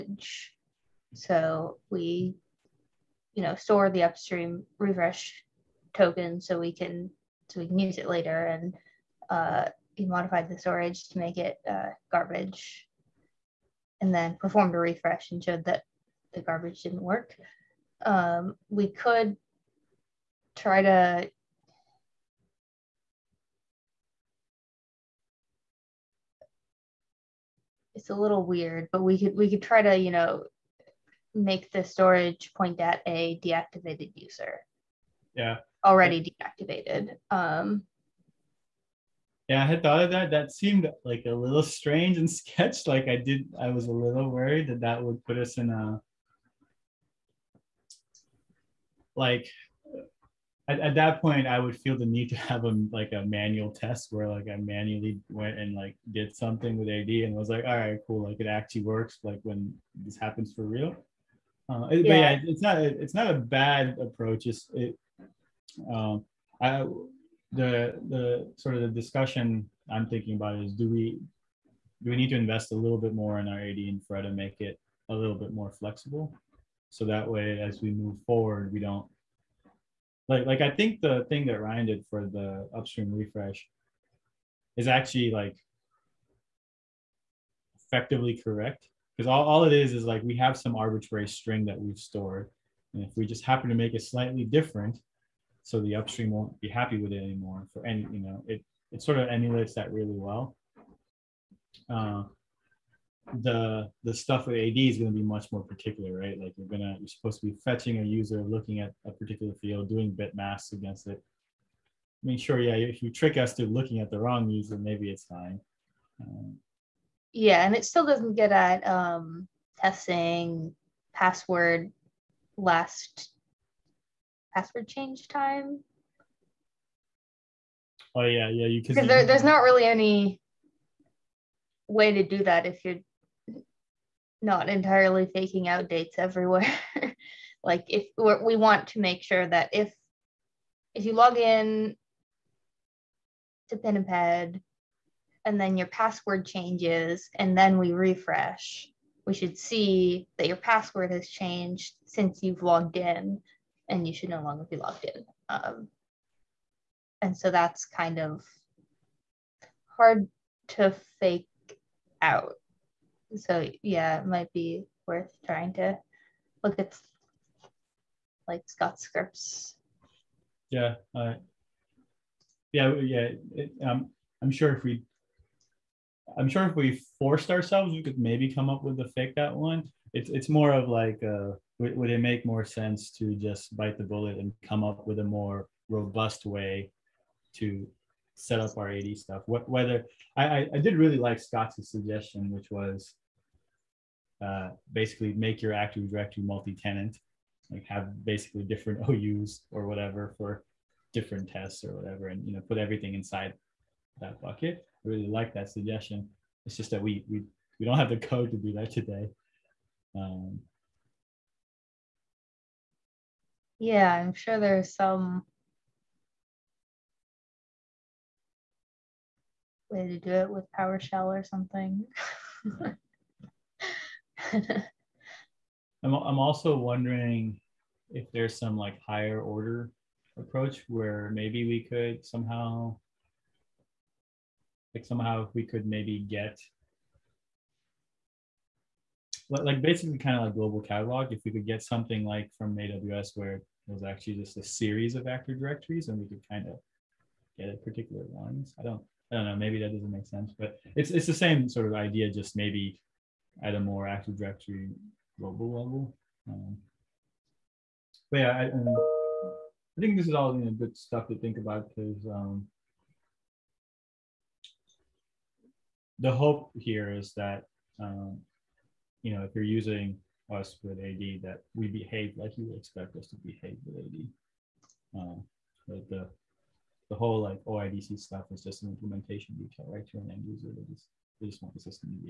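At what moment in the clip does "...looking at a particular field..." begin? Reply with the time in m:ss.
1:48.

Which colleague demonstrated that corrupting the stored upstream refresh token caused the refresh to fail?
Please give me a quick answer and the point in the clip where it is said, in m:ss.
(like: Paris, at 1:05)
Ryan, at 1:21.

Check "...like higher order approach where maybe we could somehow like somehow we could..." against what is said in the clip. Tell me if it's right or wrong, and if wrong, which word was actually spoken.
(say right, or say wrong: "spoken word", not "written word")
right.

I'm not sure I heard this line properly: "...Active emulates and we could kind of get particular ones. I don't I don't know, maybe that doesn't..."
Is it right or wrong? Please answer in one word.
wrong.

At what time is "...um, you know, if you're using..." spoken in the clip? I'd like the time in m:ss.
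4:28.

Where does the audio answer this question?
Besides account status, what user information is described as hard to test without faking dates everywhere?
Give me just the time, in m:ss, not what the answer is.
2:02.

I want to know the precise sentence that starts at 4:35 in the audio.
Um, but the the whole like OIDC stuff is just an implementation detail, right?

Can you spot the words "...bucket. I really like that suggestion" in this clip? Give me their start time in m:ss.
3:24.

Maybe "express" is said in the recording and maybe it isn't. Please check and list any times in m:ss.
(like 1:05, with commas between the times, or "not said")
not said.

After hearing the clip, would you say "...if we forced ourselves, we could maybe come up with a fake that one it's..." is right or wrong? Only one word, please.
right.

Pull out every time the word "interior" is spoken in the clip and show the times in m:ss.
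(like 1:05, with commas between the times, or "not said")
not said.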